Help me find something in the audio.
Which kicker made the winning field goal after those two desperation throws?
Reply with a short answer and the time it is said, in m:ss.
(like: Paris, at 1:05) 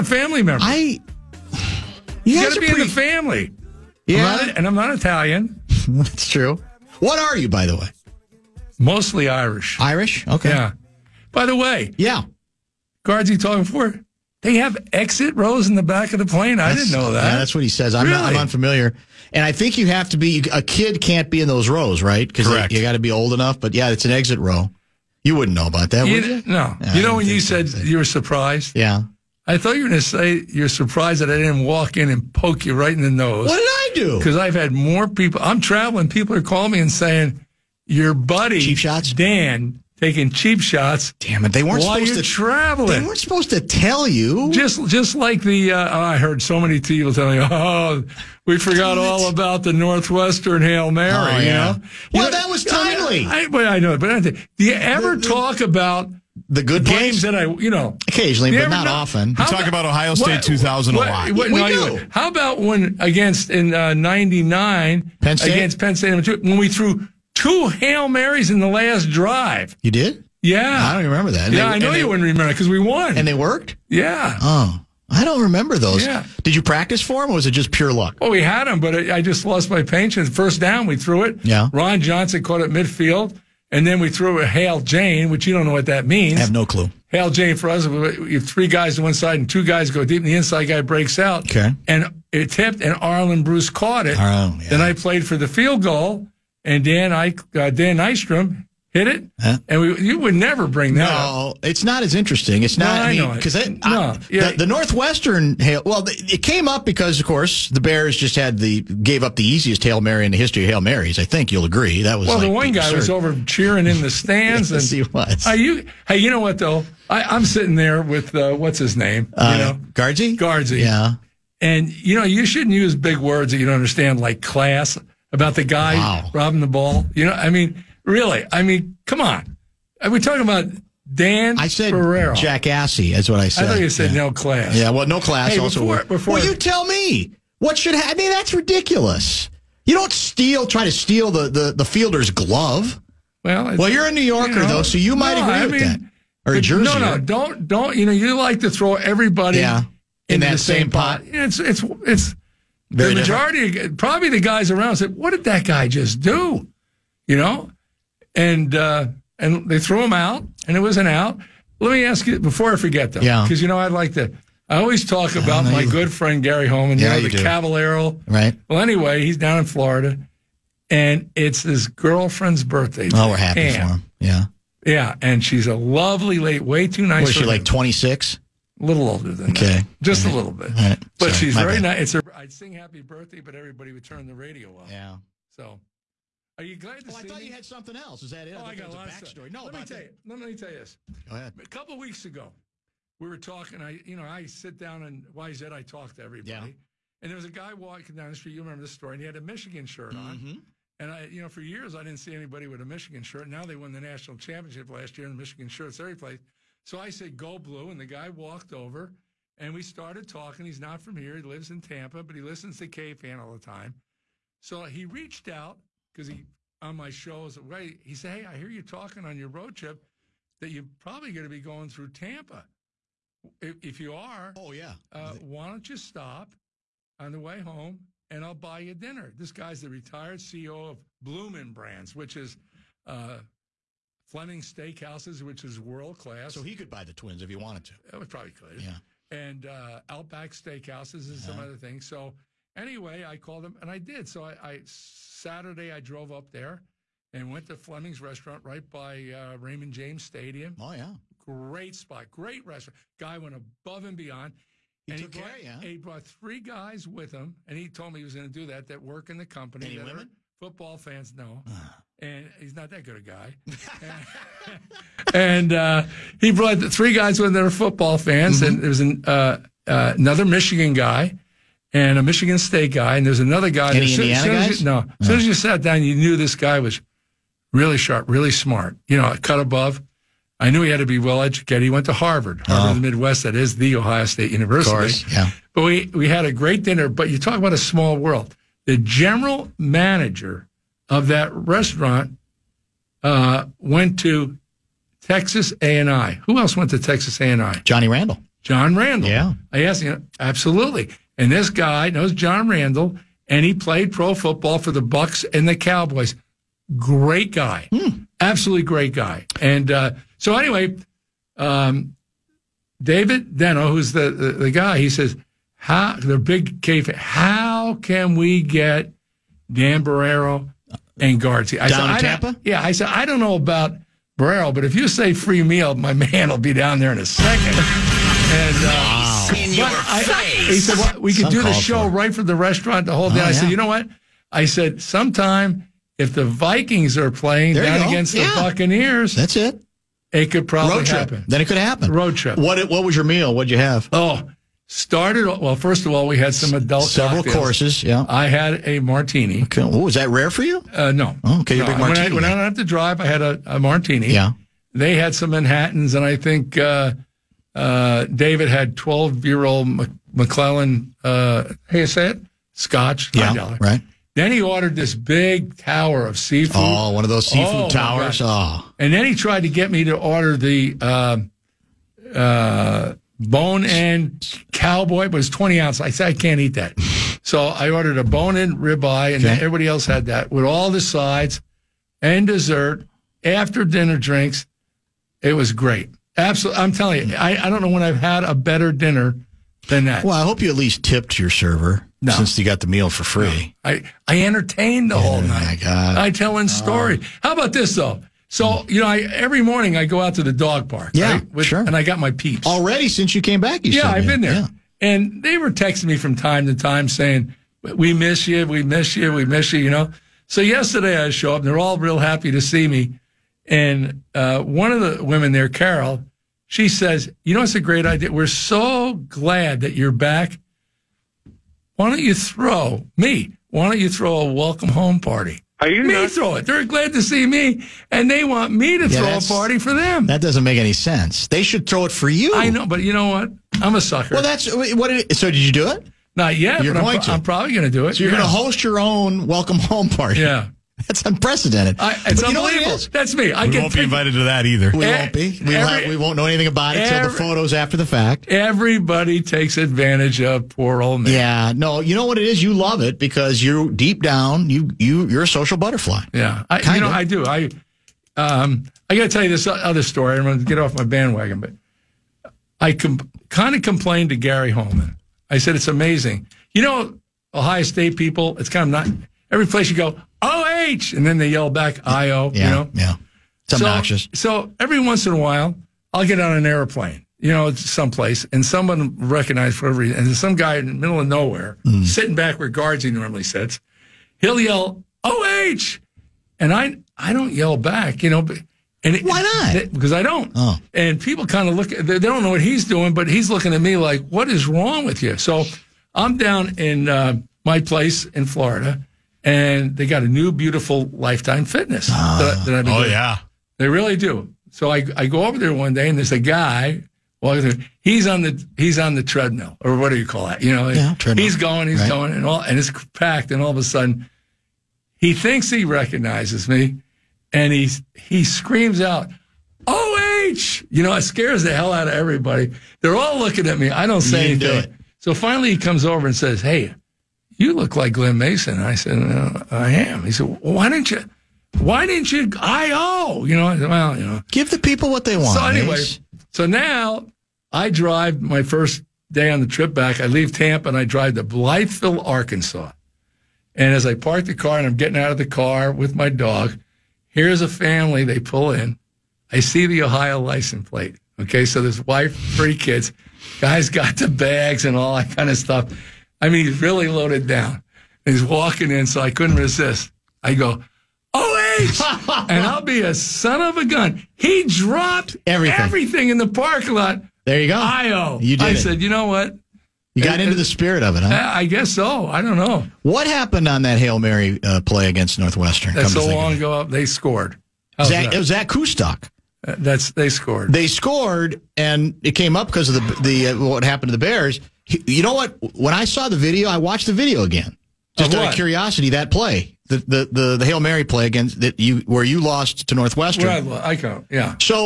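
Dan Nystrom, at 1:37.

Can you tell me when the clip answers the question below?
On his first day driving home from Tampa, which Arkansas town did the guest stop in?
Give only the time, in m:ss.
9:01.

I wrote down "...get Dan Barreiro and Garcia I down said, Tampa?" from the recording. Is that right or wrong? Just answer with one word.
right.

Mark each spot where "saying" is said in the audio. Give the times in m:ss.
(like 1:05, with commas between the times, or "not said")
0:36, 6:47.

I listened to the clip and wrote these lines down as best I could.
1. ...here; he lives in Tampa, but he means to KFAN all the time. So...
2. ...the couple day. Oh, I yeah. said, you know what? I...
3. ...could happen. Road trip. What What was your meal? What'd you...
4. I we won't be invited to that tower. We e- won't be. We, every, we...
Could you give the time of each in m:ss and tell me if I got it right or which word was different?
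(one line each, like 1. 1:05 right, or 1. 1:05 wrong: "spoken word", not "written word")
1. 3:31 wrong: "listens", not "means"
2. 5:33 wrong: "whole", not "couple"
3. 5:41 right
4. 7:23 wrong: "either", not "tower".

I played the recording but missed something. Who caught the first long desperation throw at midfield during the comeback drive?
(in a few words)
Ron Johnson.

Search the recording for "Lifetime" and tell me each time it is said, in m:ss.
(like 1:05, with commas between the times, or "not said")
8:21.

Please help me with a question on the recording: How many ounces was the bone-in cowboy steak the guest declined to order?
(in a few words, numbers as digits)
20.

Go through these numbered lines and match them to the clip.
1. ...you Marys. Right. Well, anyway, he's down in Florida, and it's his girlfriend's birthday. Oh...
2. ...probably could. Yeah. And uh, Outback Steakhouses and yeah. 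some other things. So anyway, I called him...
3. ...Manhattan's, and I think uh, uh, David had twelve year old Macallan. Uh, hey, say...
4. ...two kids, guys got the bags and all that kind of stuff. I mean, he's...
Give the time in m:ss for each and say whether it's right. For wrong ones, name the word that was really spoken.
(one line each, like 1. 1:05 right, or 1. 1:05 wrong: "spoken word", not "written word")
1. 2:47 wrong: "Cavalero", not "Marys"
2. 3:58 right
3. 5:55 right
4. 9:12 wrong: "three", not "two".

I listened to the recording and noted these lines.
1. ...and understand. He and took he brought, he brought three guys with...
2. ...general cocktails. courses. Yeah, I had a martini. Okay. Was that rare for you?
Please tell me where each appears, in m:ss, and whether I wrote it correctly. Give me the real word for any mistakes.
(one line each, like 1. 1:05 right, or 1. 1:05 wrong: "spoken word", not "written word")
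1. 4:14 wrong: "beyond", not "understand"
2. 5:47 wrong: "several", not "general".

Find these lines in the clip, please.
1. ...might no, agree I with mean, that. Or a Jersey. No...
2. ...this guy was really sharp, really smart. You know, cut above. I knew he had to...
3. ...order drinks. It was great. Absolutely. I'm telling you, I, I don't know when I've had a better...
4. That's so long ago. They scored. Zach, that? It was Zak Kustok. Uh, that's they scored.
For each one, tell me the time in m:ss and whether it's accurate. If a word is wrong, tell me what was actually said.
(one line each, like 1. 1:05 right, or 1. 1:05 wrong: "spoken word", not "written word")
1. 2:25 right
2. 4:36 right
3. 6:23 wrong: "dinner", not "order"
4. 9:35 right.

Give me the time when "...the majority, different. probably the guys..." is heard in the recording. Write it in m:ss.
2:33.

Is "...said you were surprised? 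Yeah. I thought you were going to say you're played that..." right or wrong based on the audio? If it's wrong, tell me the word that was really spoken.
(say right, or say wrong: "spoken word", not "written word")
wrong: "surprised", not "played".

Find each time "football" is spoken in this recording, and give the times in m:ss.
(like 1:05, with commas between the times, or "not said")
4:20, 4:27, 5:04.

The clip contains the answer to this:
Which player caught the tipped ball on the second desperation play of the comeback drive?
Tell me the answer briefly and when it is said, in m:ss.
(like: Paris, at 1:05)
Arland Bruce, at 1:32.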